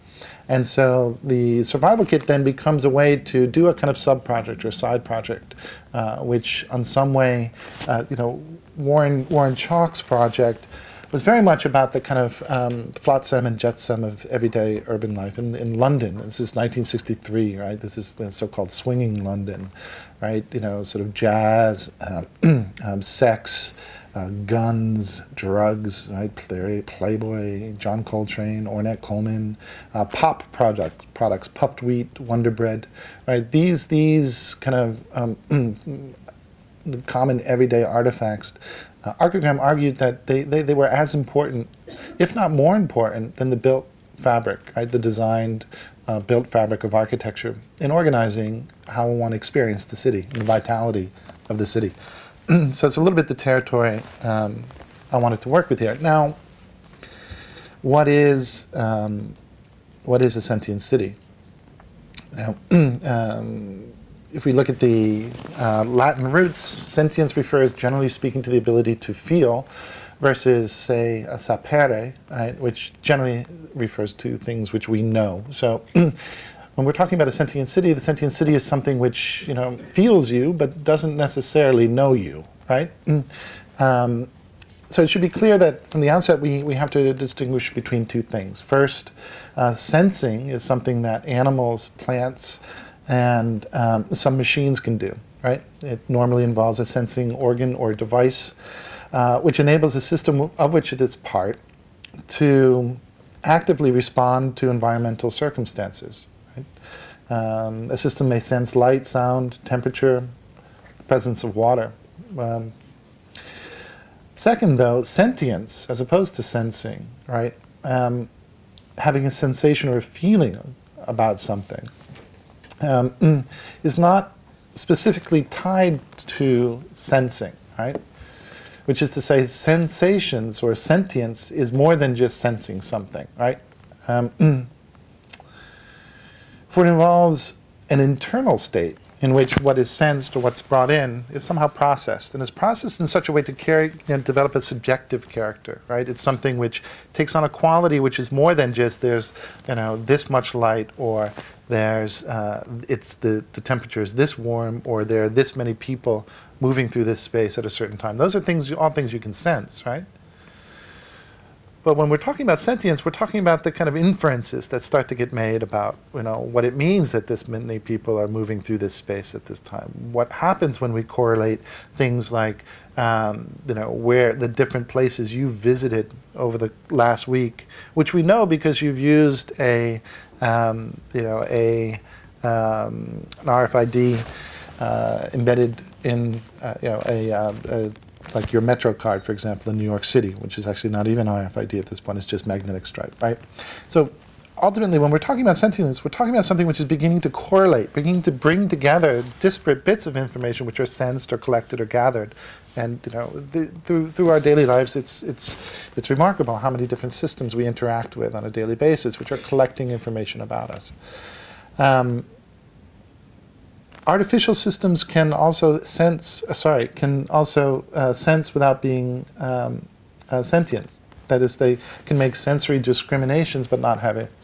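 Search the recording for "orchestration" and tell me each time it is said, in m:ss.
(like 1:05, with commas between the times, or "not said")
not said.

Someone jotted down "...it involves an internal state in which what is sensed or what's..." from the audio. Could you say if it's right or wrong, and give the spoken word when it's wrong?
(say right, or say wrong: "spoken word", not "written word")
right.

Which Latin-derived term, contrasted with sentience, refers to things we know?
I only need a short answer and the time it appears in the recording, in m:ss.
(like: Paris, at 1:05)
sapere, at 1:11.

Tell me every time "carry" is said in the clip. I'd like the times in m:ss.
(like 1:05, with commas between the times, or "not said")
2:23.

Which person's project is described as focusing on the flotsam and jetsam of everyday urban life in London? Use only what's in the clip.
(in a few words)
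Warren Chalk.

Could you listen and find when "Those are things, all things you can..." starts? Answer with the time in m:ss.
2:38.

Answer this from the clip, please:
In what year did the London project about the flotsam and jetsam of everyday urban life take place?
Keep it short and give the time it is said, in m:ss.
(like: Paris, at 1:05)
1963, at 0:16.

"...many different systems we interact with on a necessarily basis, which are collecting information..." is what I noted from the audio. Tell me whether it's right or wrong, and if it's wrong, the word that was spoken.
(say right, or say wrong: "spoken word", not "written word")
wrong: "daily", not "necessarily".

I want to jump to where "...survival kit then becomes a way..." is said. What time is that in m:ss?
0:01.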